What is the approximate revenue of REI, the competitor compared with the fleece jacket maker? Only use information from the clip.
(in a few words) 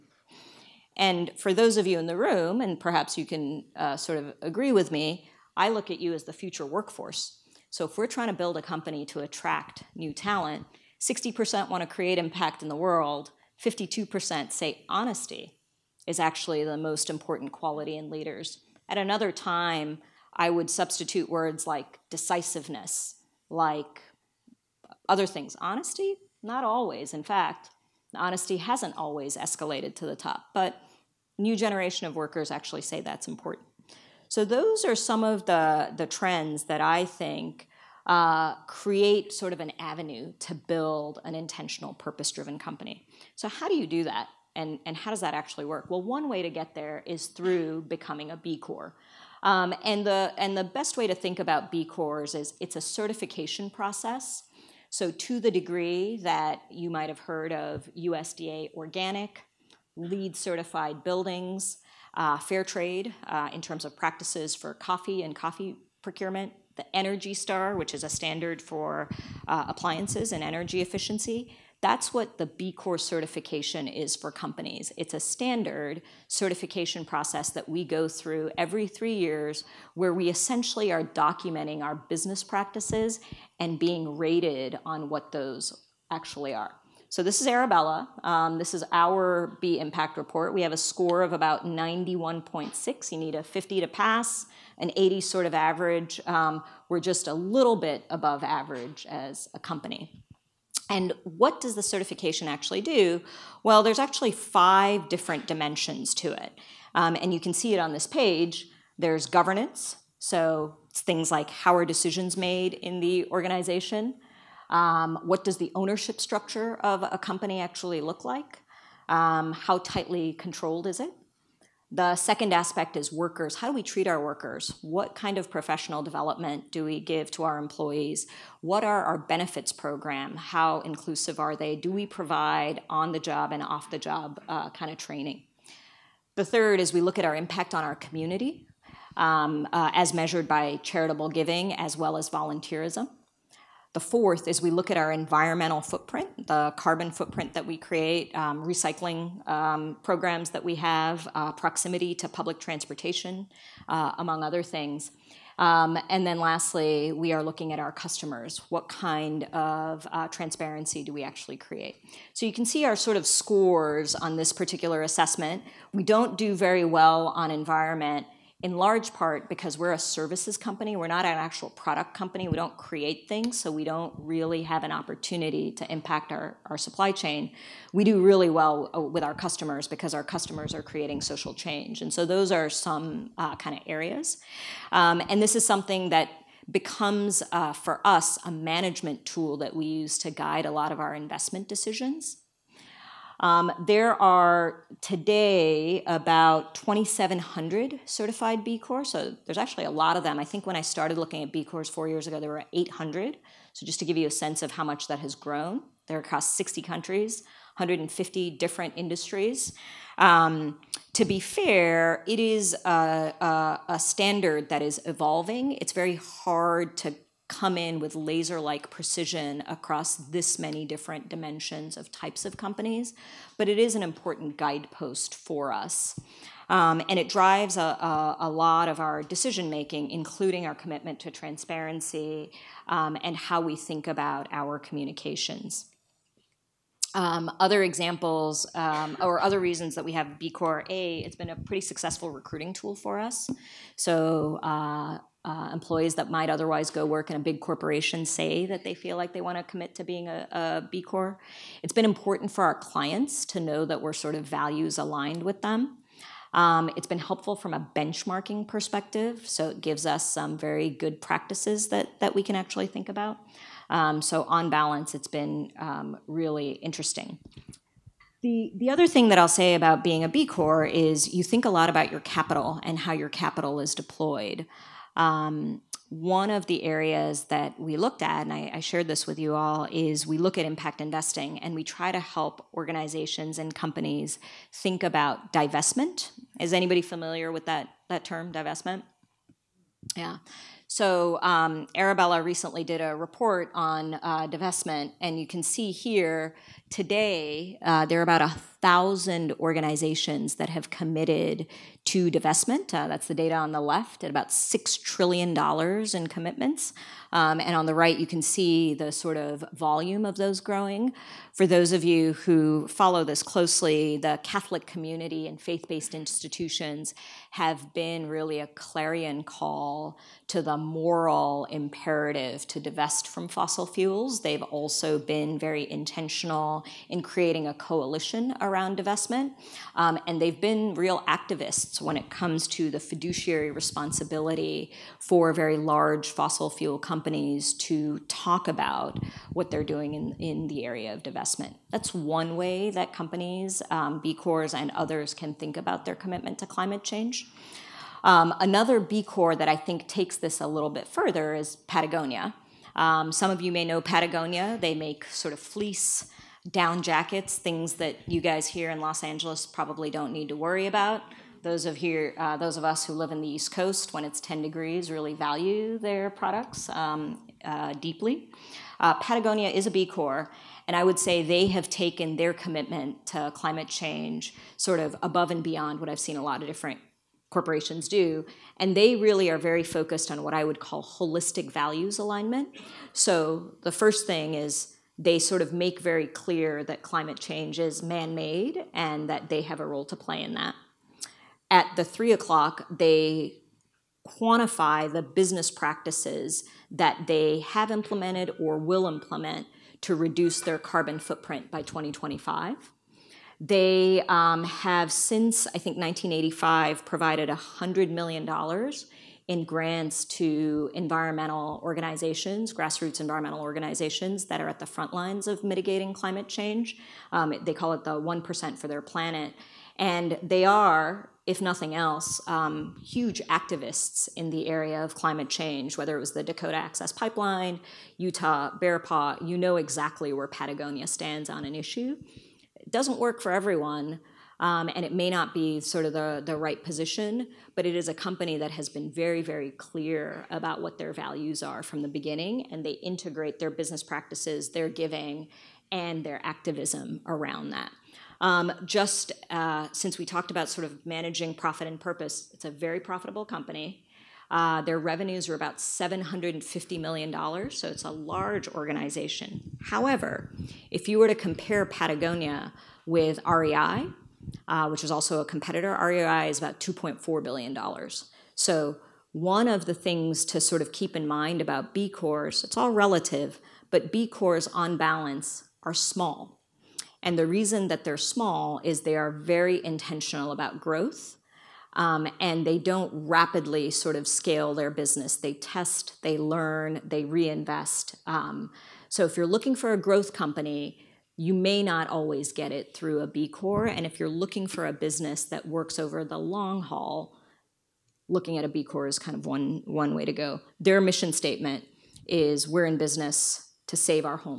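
$2.4 billion.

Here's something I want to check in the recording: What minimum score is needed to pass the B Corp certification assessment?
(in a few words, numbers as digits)
50.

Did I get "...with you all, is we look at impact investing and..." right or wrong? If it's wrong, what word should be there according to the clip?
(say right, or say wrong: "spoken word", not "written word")
right.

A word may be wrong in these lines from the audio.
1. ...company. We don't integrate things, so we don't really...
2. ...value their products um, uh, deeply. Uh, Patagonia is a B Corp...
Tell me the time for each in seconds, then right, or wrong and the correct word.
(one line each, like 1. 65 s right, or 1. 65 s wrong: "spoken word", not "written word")
1. 172 s wrong: "create", not "integrate"
2. 365 s right.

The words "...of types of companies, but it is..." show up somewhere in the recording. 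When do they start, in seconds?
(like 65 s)
221 s.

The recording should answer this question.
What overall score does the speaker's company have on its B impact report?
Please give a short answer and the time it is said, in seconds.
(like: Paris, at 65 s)
91.6, at 91 s.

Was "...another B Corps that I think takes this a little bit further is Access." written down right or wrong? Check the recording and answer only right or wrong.
wrong.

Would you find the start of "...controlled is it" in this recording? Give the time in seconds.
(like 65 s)
120 s.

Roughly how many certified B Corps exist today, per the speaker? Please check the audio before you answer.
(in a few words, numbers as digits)
2,700.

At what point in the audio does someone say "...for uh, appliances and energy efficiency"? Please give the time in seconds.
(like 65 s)
68 s.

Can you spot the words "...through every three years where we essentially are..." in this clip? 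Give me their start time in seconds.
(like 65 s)
78 s.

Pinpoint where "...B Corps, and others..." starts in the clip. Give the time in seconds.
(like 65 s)
344 s.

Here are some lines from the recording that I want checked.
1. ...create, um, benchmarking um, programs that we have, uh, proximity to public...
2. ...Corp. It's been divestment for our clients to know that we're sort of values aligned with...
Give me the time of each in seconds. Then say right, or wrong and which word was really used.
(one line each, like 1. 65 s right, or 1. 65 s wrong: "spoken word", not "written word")
1. 147 s wrong: "recycling", not "benchmarking"
2. 251 s wrong: "important", not "divestment".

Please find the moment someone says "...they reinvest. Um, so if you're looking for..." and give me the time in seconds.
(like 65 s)
487 s.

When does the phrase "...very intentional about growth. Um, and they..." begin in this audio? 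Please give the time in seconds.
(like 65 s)
479 s.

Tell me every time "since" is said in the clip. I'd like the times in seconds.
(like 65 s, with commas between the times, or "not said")
405 s, 449 s.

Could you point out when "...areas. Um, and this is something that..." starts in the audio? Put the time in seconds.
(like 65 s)
183 s.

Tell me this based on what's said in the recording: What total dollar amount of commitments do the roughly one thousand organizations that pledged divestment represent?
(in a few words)
$6 trillion.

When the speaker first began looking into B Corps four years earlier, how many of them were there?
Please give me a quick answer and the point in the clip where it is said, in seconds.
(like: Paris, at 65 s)
800, at 202 s.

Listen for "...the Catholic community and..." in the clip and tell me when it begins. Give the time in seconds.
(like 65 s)
314 s.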